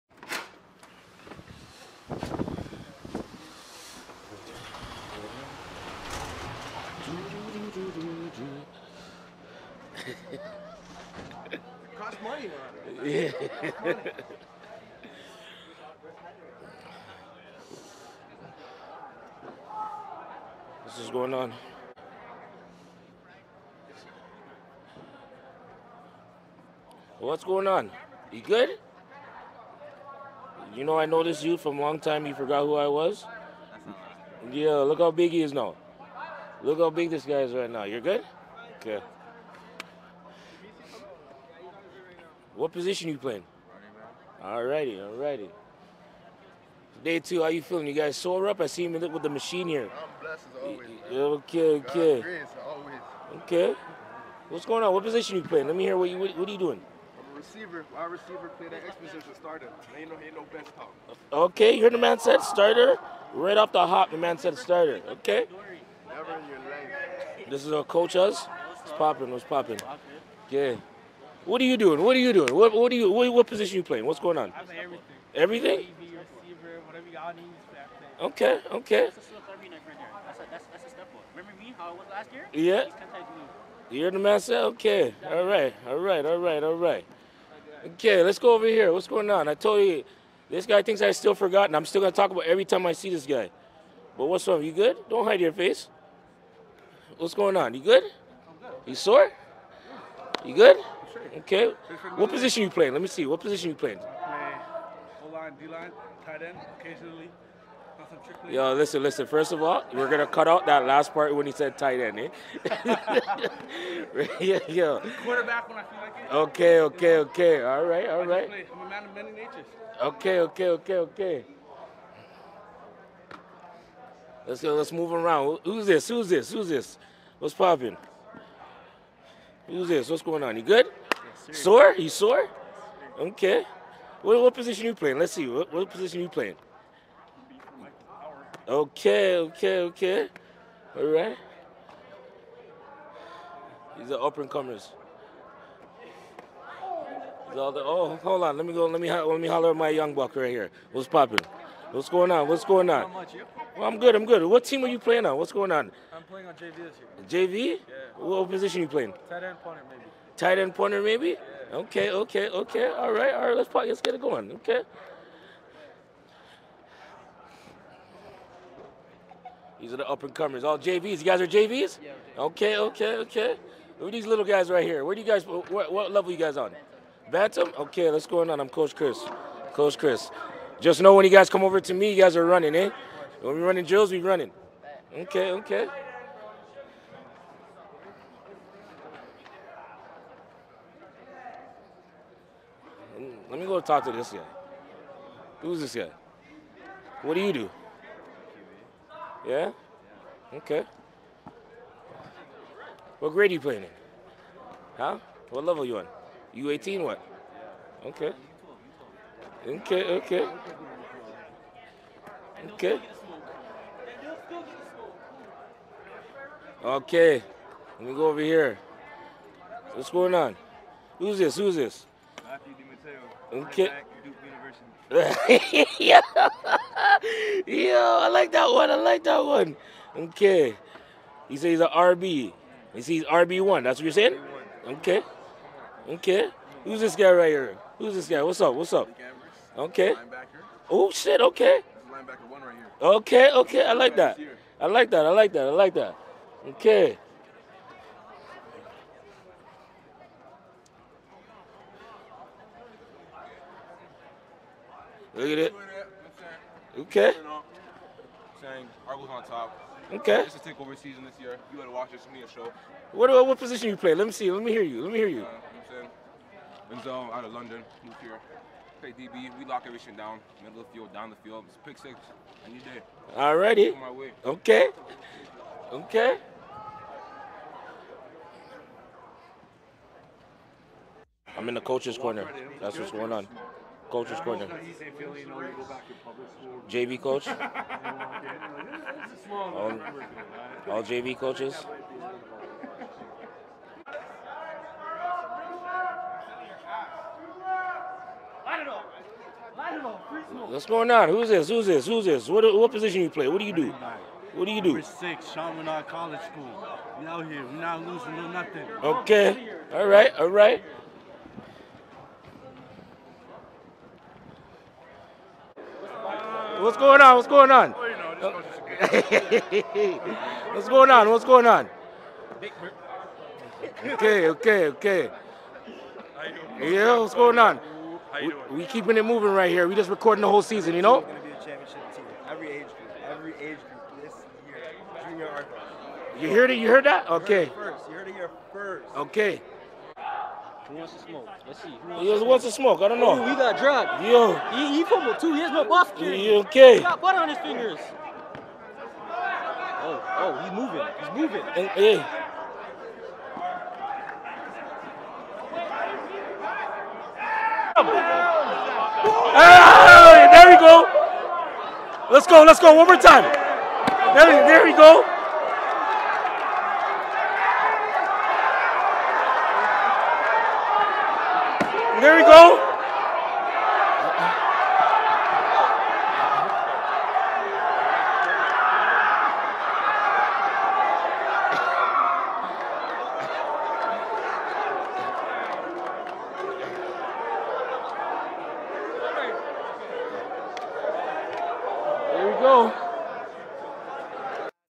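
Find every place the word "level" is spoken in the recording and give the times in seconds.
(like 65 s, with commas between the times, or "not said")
176 s, 205 s.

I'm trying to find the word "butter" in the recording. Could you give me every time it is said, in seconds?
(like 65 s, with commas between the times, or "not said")
347 s.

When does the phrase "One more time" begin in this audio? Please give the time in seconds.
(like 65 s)
362 s.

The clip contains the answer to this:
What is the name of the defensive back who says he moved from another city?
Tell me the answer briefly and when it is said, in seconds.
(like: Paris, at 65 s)
Enzo, at 267 s.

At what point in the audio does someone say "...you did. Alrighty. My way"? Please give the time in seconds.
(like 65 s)
272 s.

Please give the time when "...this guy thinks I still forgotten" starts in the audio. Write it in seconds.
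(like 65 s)
90 s.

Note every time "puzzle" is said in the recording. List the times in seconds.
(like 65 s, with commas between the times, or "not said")
not said.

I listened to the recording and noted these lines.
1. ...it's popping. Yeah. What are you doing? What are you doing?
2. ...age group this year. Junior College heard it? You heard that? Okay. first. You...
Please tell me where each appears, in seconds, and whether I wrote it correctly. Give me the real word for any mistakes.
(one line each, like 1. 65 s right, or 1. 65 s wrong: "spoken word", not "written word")
1. 69 s right
2. 333 s wrong: "You", not "College".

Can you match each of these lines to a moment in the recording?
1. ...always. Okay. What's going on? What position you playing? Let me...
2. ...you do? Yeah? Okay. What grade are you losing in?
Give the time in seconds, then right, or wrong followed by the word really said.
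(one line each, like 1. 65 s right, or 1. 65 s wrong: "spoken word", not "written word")
1. 52 s right
2. 197 s wrong: "playing", not "losing".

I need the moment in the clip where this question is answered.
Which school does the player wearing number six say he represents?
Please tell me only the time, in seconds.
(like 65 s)
305 s.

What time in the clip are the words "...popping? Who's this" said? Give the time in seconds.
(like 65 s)
127 s.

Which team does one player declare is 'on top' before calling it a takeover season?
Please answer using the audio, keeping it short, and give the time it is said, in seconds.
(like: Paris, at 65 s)
Argos, at 259 s.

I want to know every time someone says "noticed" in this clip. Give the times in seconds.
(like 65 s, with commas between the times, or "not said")
31 s.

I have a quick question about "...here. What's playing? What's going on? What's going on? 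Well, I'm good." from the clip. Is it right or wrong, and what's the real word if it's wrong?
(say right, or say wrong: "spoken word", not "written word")
wrong: "popping", not "playing".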